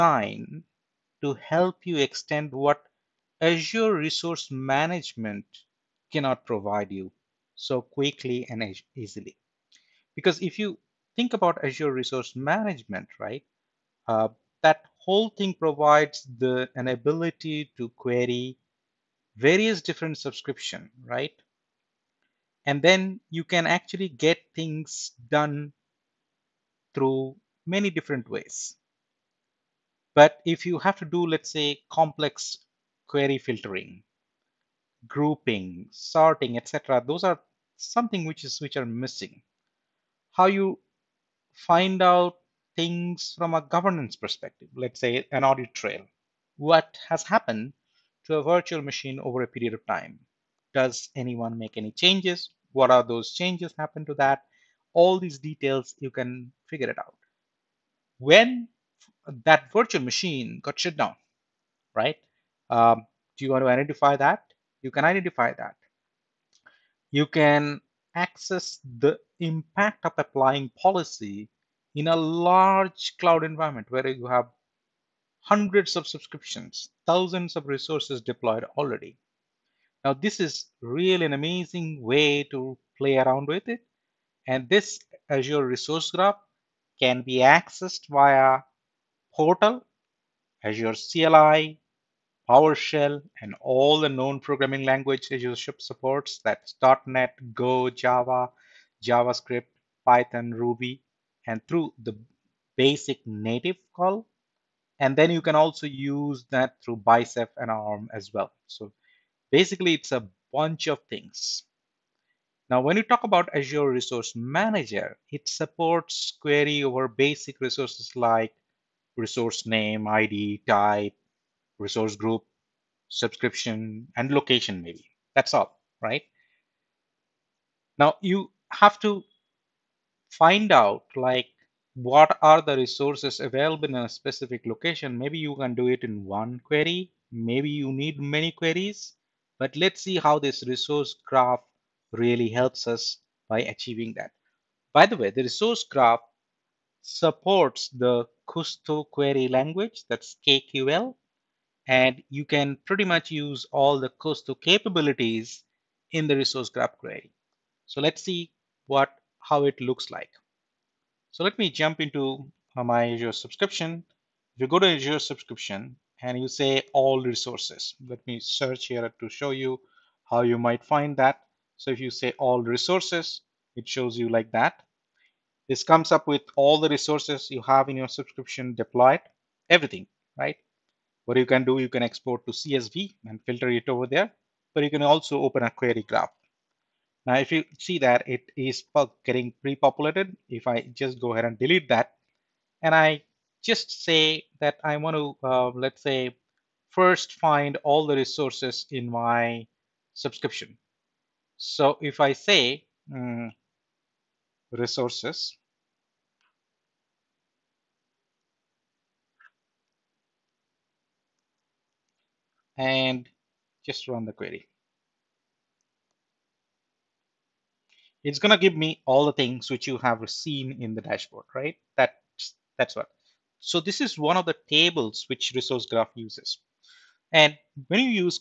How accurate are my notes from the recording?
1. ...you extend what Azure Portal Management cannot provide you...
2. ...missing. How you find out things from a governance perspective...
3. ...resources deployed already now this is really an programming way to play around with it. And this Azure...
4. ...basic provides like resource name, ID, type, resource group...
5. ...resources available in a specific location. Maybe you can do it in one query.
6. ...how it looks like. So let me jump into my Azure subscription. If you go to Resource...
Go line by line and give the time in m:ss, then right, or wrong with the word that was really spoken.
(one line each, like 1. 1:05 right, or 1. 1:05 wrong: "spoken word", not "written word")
1. 0:01 wrong: "Resource", not "Portal"
2. 0:38 right
3. 1:17 wrong: "amazing", not "programming"
4. 1:57 wrong: "resources", not "provides"
5. 2:12 right
6. 2:39 wrong: "Azure", not "Resource".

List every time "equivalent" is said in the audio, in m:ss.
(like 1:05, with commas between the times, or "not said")
not said.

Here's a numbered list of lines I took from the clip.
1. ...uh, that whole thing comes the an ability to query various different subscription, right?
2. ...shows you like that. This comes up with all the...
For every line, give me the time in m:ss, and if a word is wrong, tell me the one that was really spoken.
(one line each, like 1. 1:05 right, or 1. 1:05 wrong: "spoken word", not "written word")
1. 0:14 wrong: "provides", not "comes"
2. 2:53 right.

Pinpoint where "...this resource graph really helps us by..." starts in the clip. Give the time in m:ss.
2:20.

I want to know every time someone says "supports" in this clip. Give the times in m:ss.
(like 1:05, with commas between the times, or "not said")
1:35, 1:55, 2:27.